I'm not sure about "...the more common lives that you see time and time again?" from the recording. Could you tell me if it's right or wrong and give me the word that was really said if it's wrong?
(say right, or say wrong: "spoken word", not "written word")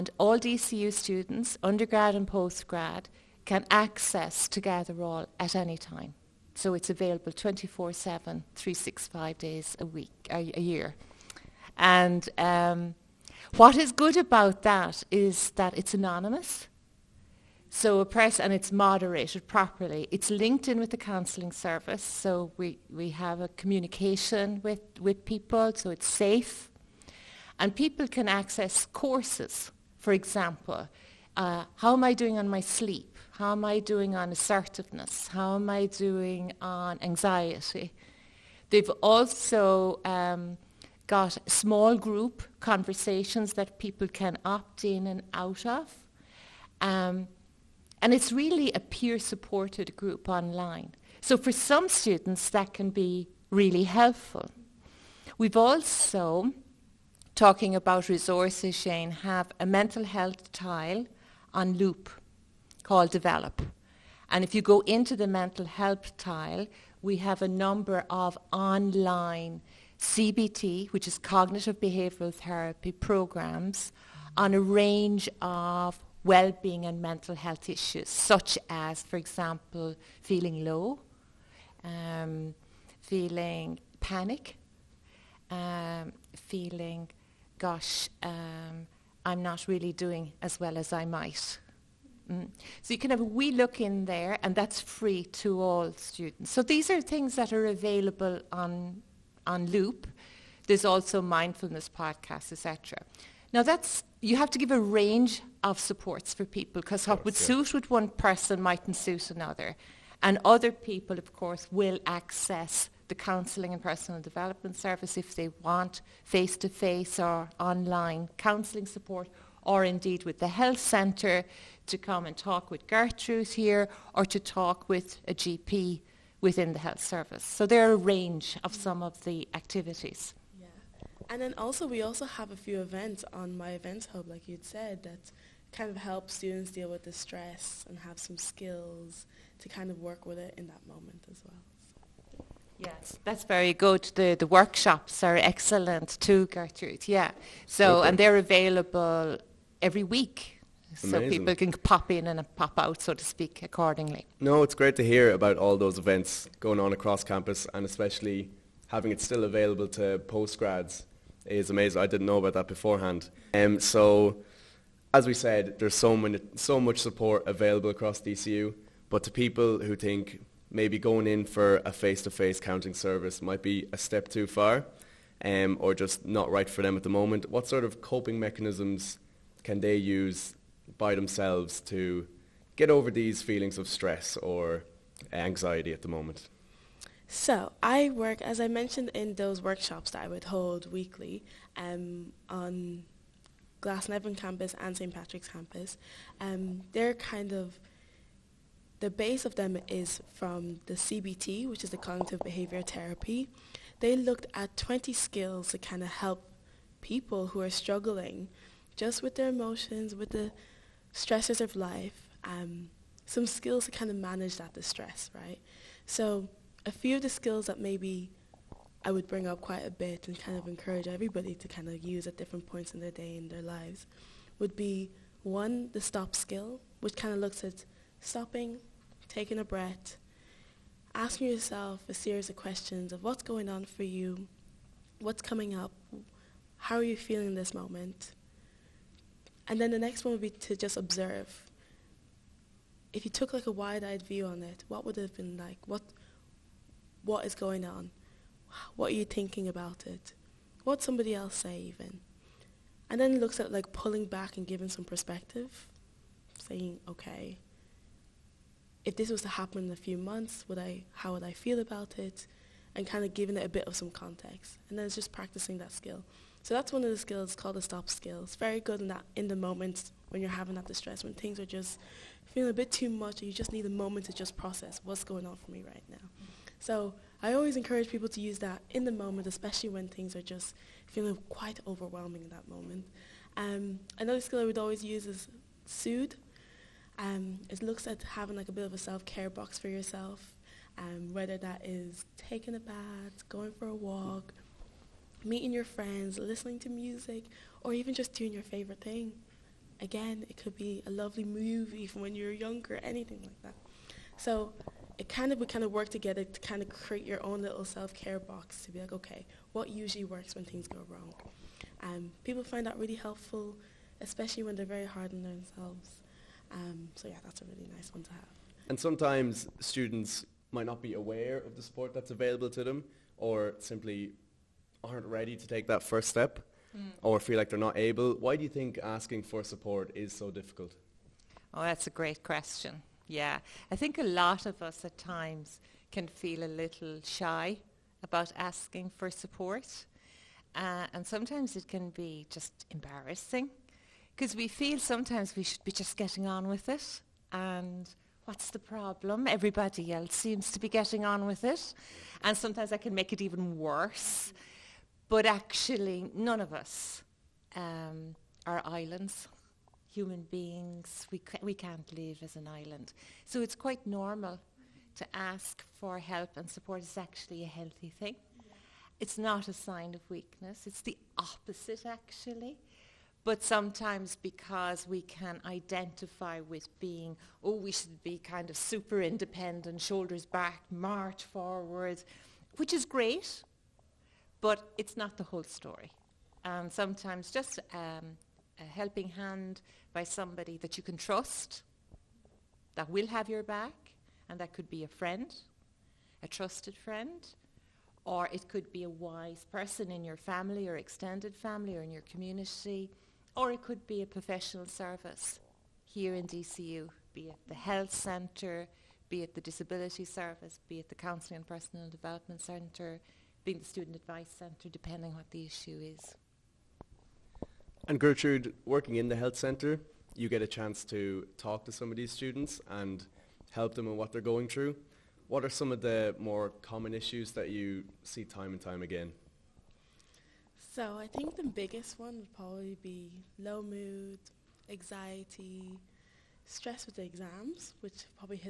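wrong: "issues", not "lives".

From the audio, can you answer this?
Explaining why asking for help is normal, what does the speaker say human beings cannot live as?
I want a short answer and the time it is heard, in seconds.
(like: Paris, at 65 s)
An island, at 362 s.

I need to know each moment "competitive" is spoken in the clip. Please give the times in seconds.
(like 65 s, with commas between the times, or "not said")
not said.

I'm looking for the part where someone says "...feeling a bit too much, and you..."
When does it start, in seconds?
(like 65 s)
272 s.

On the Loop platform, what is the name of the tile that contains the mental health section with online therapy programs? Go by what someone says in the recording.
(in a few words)
Develop.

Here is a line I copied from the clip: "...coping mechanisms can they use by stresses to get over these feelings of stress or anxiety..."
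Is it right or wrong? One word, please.
wrong.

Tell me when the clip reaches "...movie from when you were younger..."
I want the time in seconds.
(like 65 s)
301 s.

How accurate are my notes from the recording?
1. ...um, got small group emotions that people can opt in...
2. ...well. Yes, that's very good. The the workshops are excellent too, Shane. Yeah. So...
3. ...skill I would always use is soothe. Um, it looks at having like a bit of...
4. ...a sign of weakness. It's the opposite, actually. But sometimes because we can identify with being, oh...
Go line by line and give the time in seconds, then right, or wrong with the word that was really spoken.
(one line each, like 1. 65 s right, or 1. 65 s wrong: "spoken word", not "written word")
1. 40 s wrong: "conversations", not "emotions"
2. 141 s wrong: "Gertrude", not "Shane"
3. 284 s right
4. 369 s right.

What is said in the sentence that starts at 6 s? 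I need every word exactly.
So it's available 24-7, 365 days a week, a, a year.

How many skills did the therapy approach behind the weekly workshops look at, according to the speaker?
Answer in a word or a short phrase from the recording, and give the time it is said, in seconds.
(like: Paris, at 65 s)
20, at 204 s.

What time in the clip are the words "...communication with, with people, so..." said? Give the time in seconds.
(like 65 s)
23 s.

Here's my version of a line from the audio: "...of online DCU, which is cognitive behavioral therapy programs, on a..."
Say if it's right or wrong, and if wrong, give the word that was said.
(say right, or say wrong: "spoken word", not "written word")
wrong: "CBT", not "DCU".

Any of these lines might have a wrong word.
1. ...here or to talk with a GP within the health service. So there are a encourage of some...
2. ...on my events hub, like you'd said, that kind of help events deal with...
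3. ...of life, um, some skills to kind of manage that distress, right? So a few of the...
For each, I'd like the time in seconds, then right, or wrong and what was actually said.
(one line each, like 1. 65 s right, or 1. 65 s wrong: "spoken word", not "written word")
1. 123 s wrong: "range", not "encourage"
2. 133 s wrong: "students", not "events"
3. 211 s right.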